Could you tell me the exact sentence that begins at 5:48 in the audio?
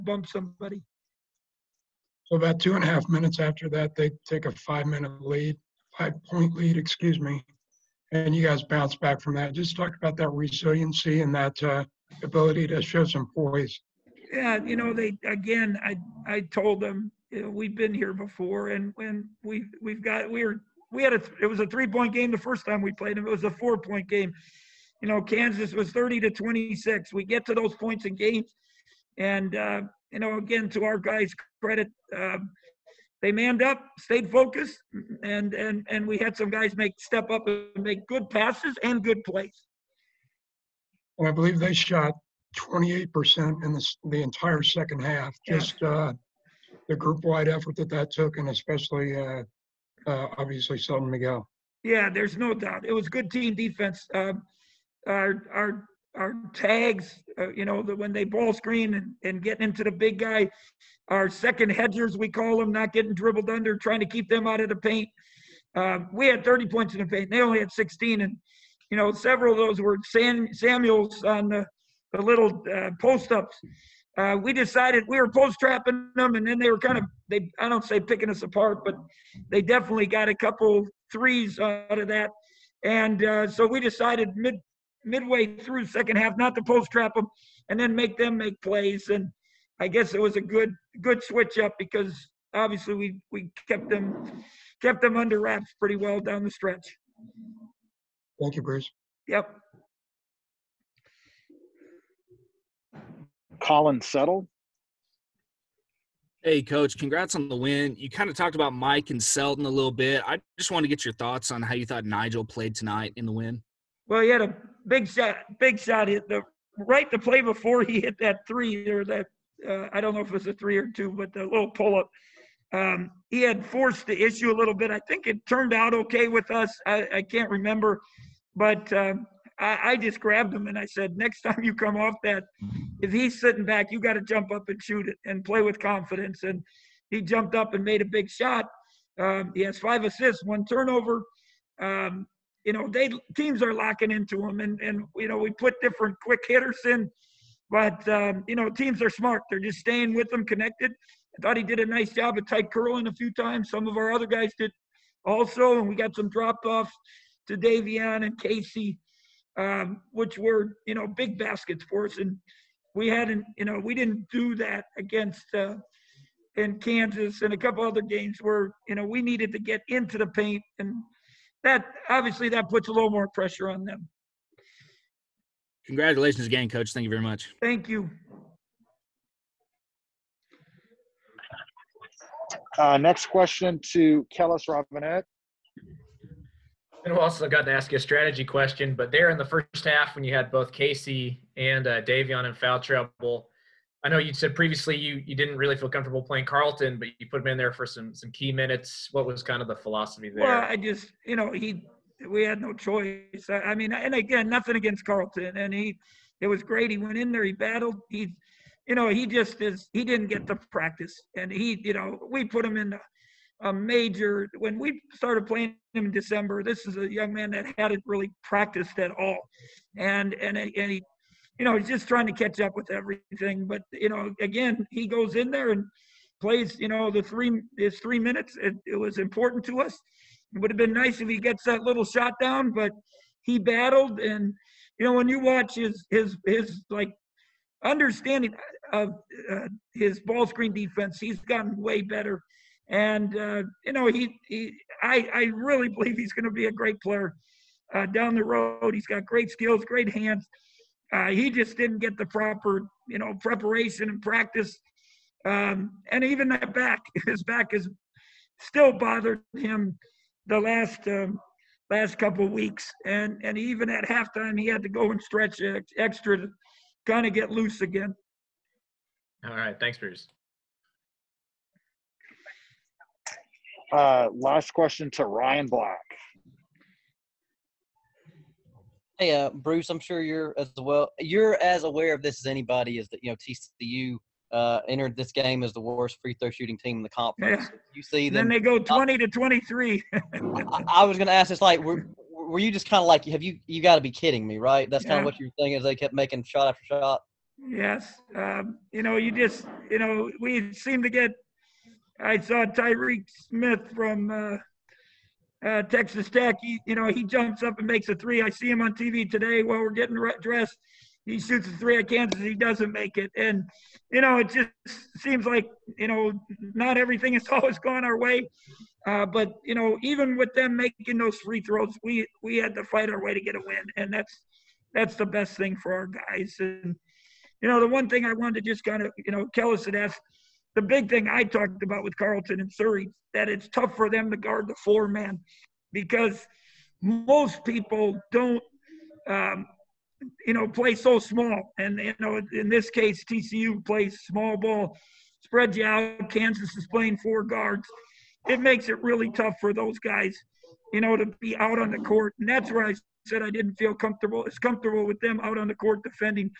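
It makes it really tough for those guys, you know, to be out on the court.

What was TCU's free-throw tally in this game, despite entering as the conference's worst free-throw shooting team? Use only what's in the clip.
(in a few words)
20 of 23.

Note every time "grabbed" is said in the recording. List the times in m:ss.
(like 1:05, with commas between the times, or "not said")
2:10.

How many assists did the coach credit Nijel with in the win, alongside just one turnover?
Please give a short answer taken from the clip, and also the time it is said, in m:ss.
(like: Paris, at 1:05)
5, at 2:19.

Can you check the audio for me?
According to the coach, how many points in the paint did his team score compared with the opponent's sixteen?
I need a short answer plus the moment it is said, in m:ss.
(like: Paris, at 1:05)
30, at 1:06.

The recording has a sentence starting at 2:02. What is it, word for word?
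Um, he had forced the issue a little bit.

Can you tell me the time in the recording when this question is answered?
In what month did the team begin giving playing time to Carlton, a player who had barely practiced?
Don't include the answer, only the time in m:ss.
3:36.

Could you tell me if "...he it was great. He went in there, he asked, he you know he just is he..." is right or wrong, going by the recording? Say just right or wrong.
wrong.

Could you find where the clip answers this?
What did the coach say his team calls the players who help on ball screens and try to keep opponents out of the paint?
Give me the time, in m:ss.
1:01.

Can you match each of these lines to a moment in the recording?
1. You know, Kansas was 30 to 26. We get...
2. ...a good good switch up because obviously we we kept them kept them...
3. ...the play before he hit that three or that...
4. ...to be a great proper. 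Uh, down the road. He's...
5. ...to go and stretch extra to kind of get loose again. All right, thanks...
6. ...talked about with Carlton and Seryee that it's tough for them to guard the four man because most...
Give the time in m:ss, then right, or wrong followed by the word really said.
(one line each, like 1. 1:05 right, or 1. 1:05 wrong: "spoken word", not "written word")
1. 0:25 right
2. 1:30 right
3. 1:57 right
4. 4:06 wrong: "player", not "proper"
5. 4:24 right
6. 5:31 right.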